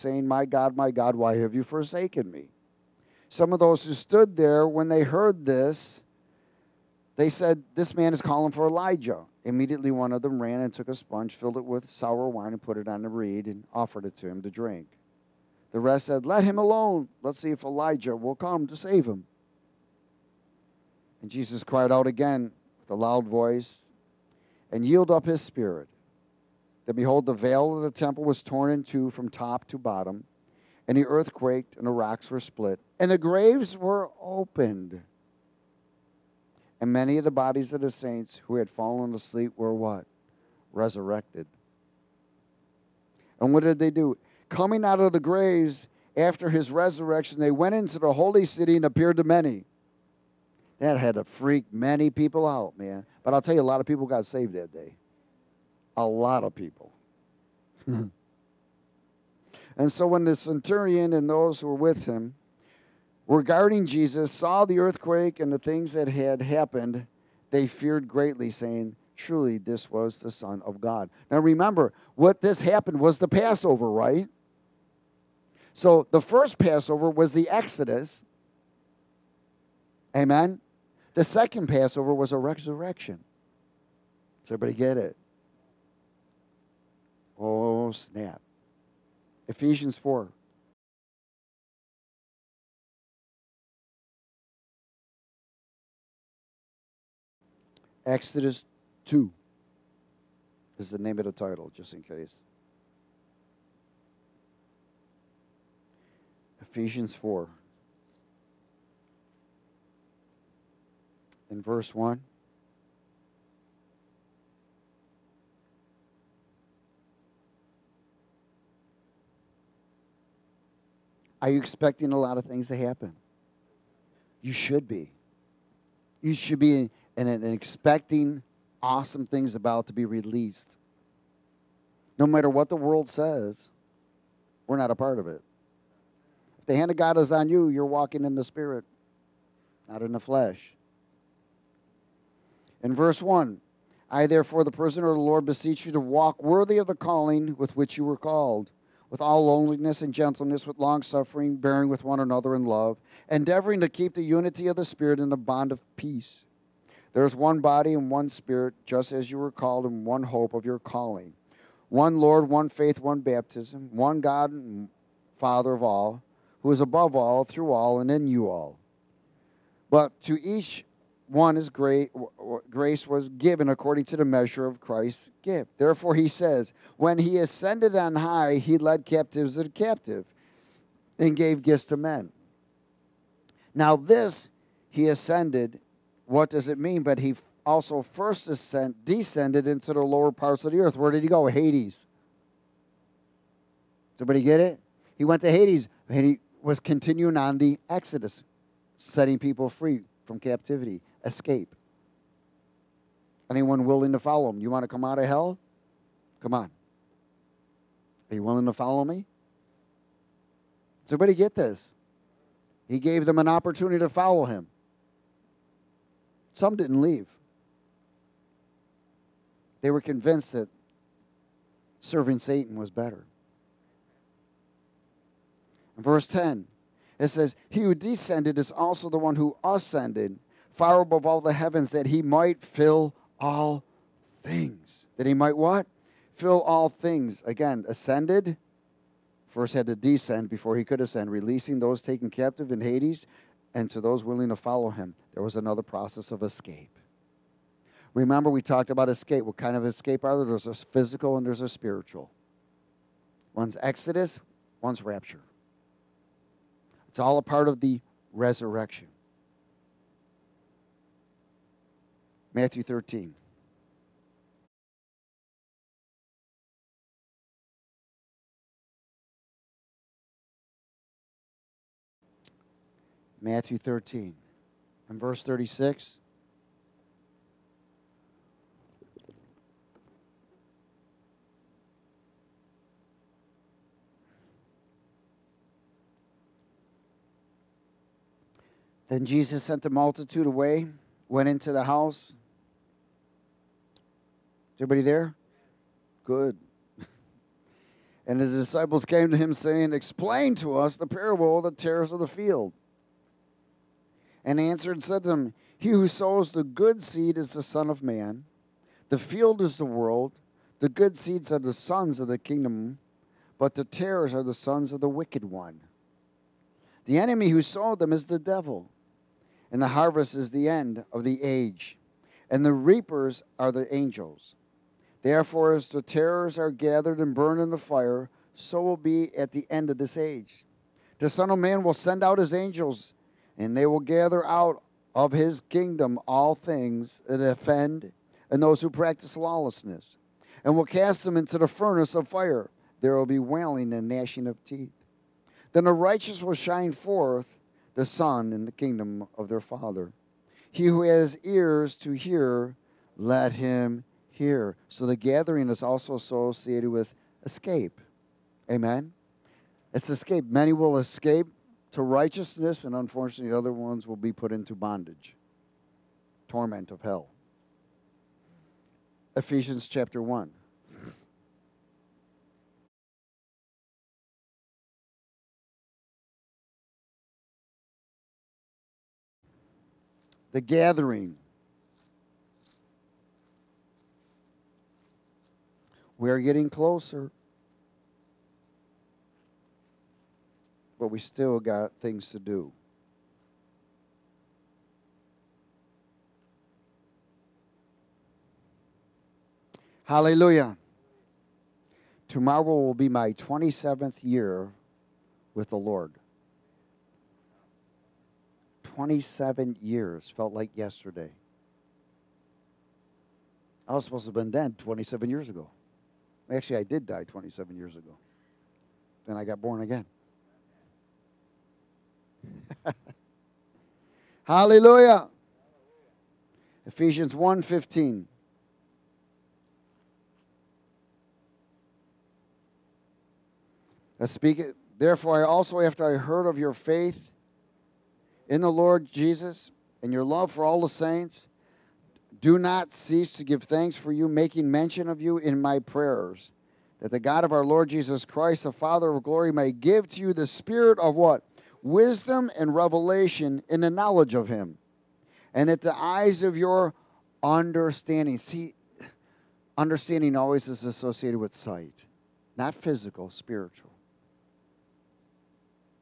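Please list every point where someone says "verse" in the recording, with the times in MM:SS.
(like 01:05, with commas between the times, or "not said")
01:51, 02:22, 03:46, 04:35.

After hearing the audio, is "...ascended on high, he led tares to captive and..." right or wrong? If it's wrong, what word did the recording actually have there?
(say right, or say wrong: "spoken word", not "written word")
wrong: "captives", not "tares".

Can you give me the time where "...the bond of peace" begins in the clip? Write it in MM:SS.
02:35.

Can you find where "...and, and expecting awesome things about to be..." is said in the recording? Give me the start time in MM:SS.
02:07.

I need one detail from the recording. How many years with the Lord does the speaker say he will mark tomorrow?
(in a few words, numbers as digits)
27.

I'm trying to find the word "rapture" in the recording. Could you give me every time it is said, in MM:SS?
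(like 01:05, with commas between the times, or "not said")
04:15.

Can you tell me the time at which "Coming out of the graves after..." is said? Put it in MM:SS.
00:44.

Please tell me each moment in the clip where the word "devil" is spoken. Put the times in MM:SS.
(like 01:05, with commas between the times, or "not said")
05:18.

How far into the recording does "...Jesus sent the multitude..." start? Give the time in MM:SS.
04:49.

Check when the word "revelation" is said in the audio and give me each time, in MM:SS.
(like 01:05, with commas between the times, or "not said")
07:32.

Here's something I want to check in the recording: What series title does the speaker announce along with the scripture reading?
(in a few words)
Exodus 2.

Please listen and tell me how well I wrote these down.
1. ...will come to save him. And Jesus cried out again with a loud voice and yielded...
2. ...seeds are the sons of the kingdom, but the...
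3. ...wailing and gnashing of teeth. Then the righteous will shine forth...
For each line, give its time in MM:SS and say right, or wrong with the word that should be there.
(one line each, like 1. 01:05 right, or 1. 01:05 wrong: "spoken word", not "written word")
1. 00:18 right
2. 05:11 right
3. 05:43 right.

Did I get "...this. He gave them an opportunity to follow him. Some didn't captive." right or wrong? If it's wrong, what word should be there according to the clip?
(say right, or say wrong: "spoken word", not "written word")
wrong: "leave", not "captive".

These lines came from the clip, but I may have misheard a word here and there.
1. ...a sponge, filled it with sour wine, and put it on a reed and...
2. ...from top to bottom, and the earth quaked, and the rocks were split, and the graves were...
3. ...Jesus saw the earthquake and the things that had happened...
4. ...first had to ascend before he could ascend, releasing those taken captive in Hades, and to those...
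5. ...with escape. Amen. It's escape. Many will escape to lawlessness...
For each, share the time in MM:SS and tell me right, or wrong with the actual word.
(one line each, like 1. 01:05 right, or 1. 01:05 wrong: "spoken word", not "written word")
1. 00:10 right
2. 00:29 right
3. 01:03 right
4. 03:59 wrong: "descend", not "ascend"
5. 05:56 wrong: "righteousness", not "lawlessness".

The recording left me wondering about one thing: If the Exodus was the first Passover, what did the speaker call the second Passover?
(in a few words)
The resurrection.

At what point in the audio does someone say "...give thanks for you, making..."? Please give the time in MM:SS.
07:23.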